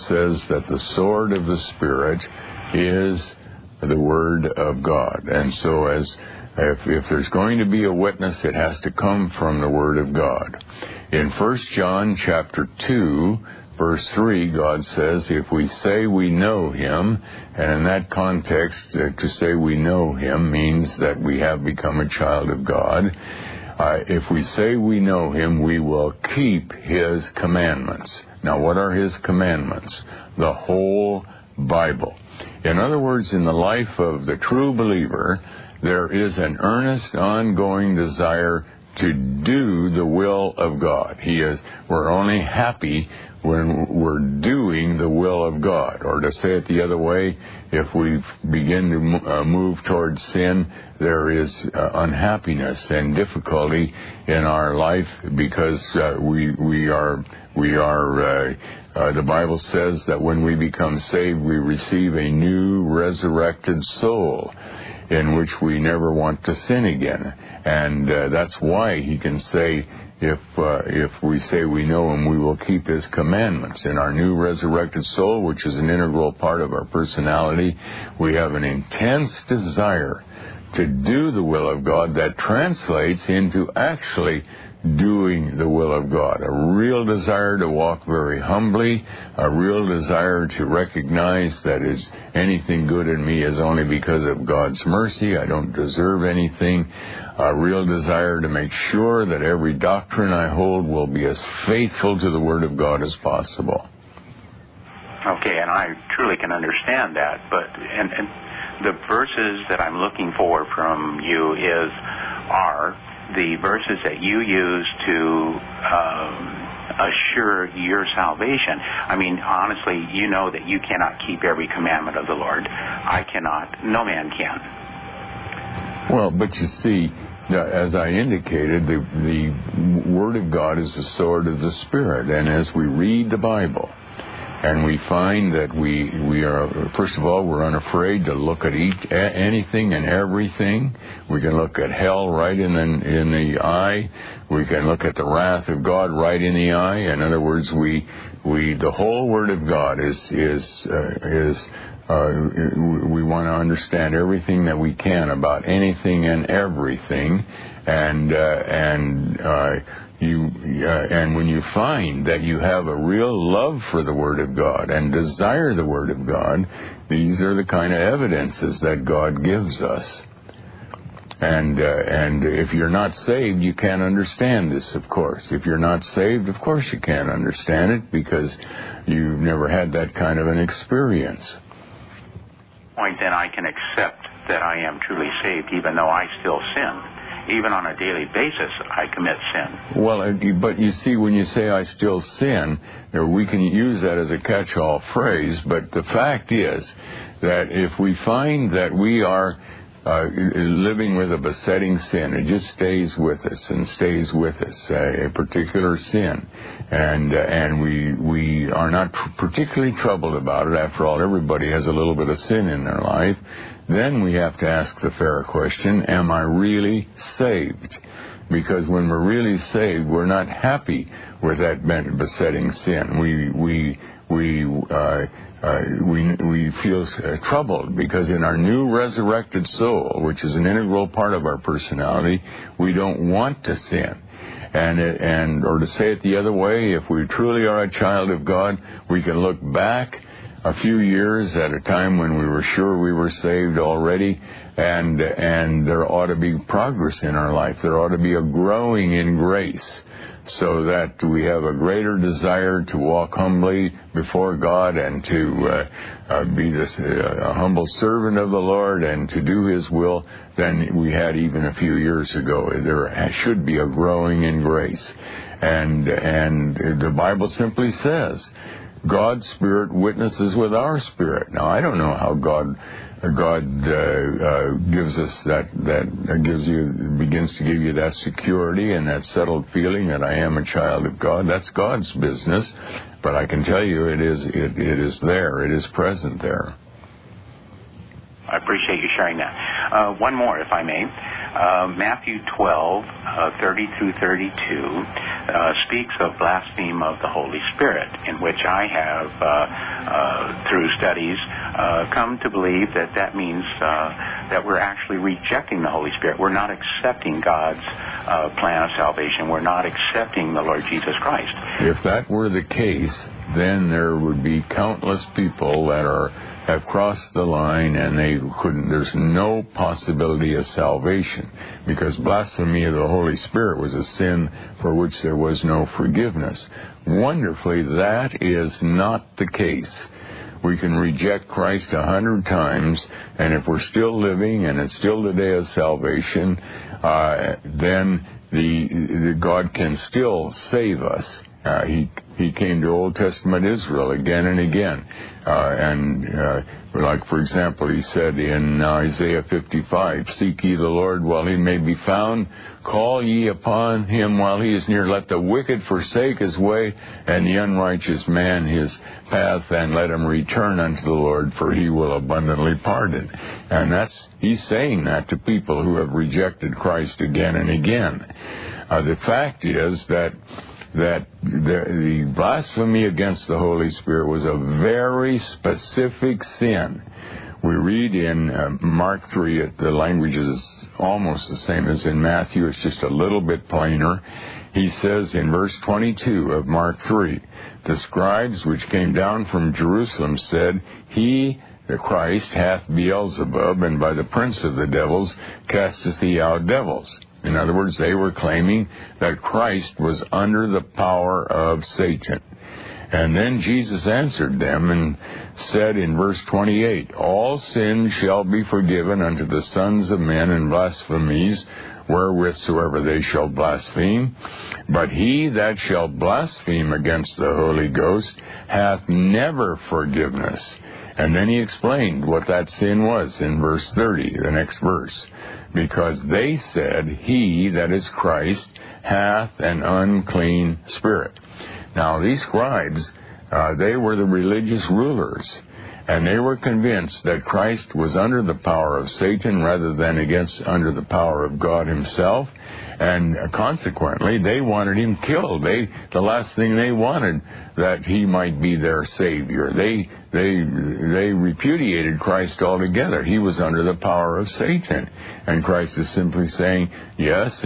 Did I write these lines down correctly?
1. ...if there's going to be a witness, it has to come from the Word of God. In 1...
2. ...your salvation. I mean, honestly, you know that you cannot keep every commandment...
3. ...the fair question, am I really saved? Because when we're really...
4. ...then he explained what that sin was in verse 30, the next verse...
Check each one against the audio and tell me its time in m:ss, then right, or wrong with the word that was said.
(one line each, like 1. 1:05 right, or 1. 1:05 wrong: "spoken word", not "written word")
1. 0:06 right
2. 1:57 right
3. 3:35 right
4. 7:01 right.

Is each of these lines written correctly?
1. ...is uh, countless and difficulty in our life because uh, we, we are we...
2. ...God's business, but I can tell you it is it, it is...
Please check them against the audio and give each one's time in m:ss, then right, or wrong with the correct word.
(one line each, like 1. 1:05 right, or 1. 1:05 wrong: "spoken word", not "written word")
1. 0:51 wrong: "unhappiness", not "countless"
2. 4:41 right.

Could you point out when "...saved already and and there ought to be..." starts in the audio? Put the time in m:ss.
4:03.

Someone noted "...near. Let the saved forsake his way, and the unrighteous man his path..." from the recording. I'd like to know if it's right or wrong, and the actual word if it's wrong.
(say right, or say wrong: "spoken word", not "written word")
wrong: "wicked", not "saved".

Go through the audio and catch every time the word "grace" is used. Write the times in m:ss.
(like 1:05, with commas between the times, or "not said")
4:09, 4:24.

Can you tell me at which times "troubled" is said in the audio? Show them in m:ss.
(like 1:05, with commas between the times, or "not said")
3:29, 3:47.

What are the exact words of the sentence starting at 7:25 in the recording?
They, the last thing they wanted, that he might be their savior.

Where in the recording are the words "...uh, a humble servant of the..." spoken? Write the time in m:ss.
4:16.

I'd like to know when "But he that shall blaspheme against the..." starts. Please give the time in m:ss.
6:54.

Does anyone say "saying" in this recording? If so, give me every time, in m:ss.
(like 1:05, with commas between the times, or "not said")
6:04, 7:36.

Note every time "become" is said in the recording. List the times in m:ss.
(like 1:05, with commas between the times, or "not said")
0:21, 1:00.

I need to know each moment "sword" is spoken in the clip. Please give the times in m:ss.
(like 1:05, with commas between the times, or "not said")
0:00, 2:11.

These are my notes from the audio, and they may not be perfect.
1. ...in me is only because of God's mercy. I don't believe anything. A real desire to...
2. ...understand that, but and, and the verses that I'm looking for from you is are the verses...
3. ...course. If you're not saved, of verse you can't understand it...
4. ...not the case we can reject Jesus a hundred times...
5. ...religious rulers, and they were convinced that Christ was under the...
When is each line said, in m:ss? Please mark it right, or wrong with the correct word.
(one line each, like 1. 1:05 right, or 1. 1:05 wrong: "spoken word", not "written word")
1. 1:33 wrong: "deserve", not "believe"
2. 1:46 right
3. 2:55 wrong: "course", not "verse"
4. 5:28 wrong: "Christ", not "Jesus"
5. 7:14 right.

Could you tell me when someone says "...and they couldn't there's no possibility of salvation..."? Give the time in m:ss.
5:17.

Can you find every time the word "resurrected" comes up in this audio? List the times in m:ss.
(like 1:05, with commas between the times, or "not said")
1:02, 1:14, 3:48.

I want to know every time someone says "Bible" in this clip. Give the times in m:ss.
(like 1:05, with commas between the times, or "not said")
0:31, 0:59, 2:13, 4:27.